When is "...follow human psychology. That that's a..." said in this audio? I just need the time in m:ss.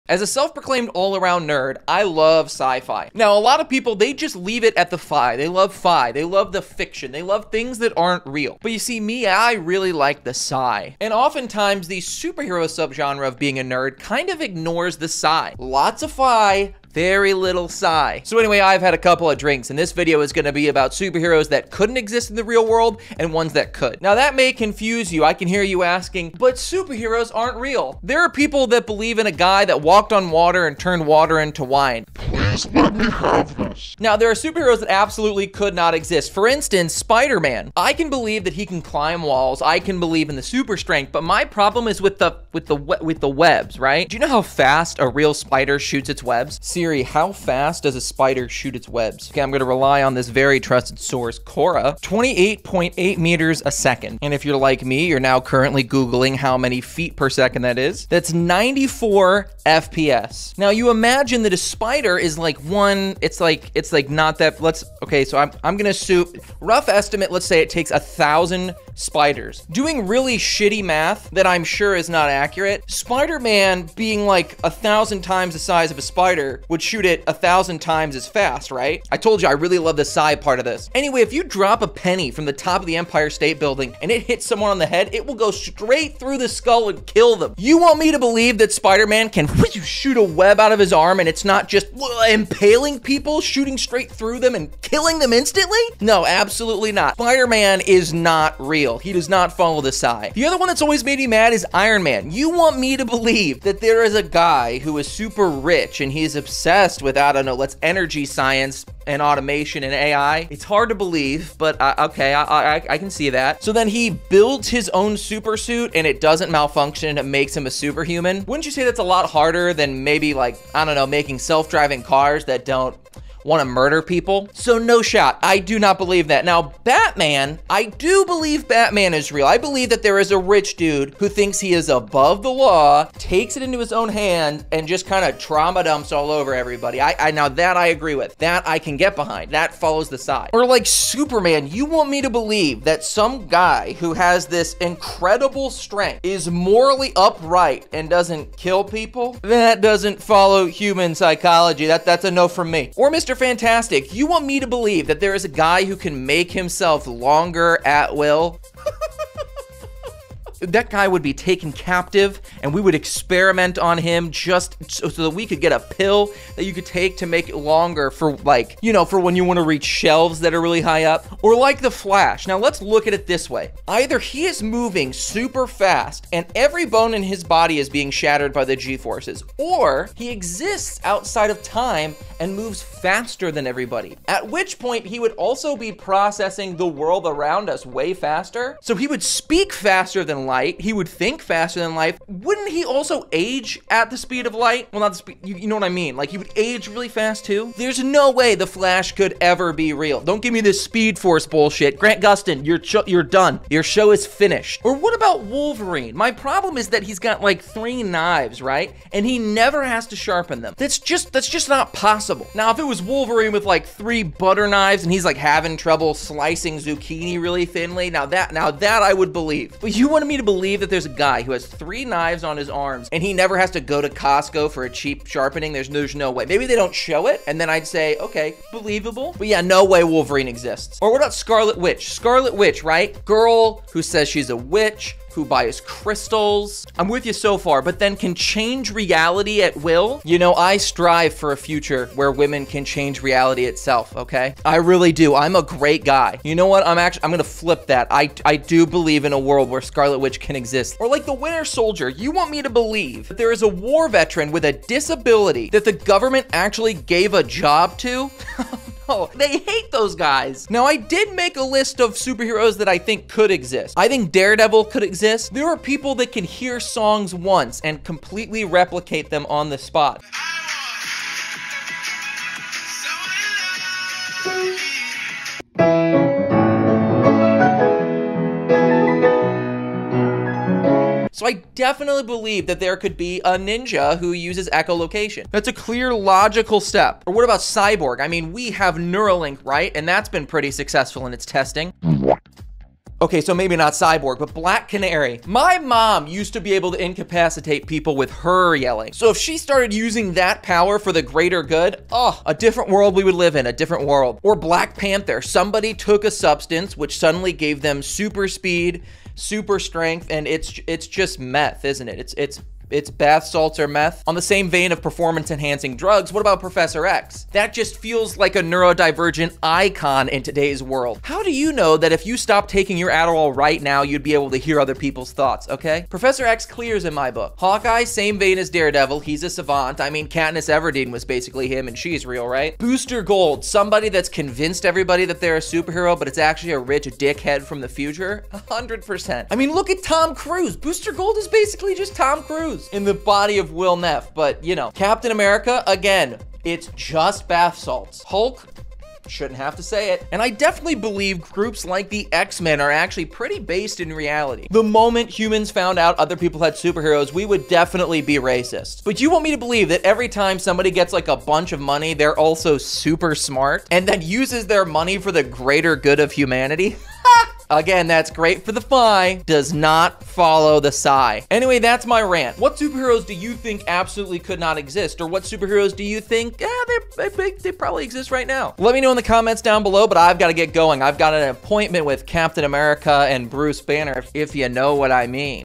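2:30.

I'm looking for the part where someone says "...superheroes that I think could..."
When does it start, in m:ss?
4:22.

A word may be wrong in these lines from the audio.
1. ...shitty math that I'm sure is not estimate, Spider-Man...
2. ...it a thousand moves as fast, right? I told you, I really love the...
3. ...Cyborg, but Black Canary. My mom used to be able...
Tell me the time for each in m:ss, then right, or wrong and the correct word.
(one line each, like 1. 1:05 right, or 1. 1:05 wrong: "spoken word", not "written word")
1. 1:10 wrong: "accurate", not "estimate"
2. 1:17 wrong: "times", not "moves"
3. 4:53 right.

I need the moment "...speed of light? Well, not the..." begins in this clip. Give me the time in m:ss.
3:14.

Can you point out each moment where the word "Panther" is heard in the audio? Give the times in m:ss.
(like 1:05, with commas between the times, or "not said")
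5:04.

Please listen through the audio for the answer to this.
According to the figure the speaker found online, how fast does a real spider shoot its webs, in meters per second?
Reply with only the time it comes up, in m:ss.
0:52.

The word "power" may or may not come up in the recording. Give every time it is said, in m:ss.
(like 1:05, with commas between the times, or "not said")
5:00.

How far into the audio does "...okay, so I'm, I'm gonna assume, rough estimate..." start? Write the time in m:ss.
1:05.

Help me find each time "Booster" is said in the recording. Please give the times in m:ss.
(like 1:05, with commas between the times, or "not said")
5:32, 5:40.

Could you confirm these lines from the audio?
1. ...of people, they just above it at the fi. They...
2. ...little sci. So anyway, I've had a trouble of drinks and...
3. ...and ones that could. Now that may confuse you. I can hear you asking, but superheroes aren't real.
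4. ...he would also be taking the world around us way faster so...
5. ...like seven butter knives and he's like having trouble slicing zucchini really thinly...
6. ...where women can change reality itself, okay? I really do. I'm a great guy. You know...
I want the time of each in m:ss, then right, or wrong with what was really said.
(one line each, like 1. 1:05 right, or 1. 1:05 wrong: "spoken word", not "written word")
1. 0:03 wrong: "leave", not "above"
2. 0:17 wrong: "couple", not "trouble"
3. 0:23 right
4. 3:05 wrong: "processing", not "taking"
5. 3:33 wrong: "three", not "seven"
6. 4:02 right.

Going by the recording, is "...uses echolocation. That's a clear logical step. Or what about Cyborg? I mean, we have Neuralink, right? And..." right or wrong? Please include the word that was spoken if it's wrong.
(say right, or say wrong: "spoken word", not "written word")
right.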